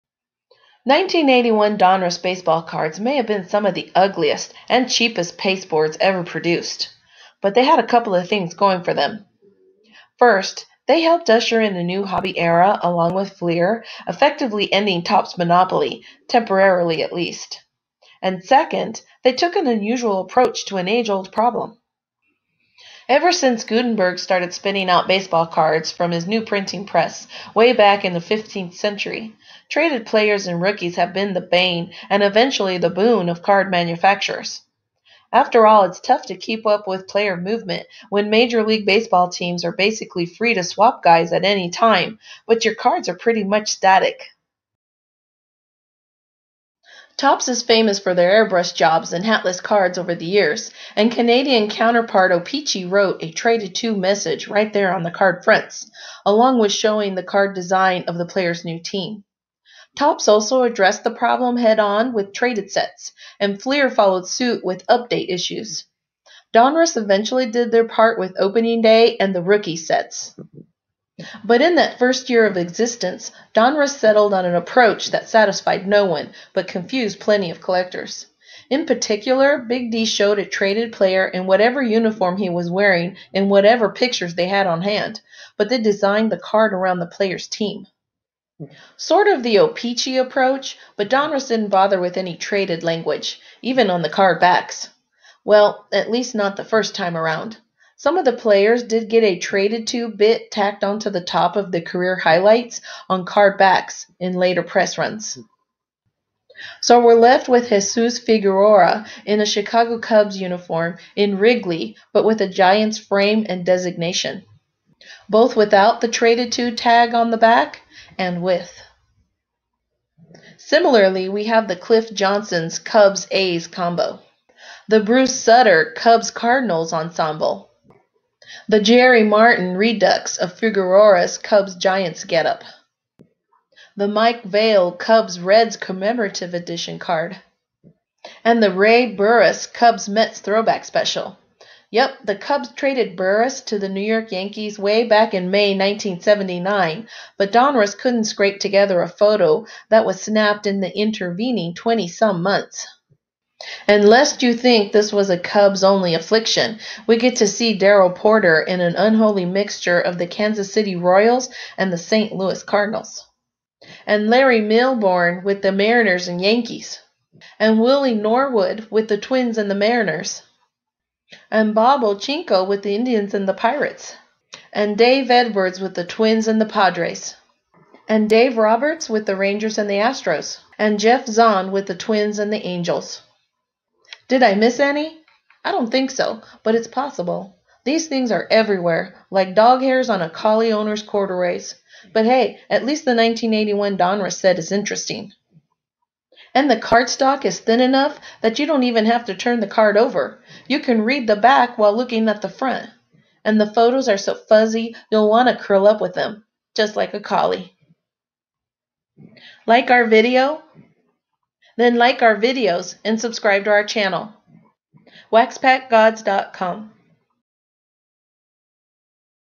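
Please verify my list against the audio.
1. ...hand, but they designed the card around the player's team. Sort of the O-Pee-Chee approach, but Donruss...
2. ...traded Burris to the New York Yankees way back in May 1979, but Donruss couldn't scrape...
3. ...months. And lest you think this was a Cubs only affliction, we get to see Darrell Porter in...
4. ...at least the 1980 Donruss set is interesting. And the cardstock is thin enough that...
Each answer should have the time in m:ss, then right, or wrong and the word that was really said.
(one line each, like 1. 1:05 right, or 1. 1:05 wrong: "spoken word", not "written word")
1. 1:24 right
2. 2:22 right
3. 2:32 right
4. 3:12 wrong: "1981", not "1980".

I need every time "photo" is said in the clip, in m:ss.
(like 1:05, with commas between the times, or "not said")
2:29, 3:23.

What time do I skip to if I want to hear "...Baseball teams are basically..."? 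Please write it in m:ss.
0:38.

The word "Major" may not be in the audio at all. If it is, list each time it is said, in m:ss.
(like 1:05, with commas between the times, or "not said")
0:38.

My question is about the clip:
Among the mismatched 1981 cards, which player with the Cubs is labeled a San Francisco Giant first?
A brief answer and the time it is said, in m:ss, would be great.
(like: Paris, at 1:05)
Jesus Figueroa, at 1:47.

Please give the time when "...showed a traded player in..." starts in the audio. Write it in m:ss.
1:20.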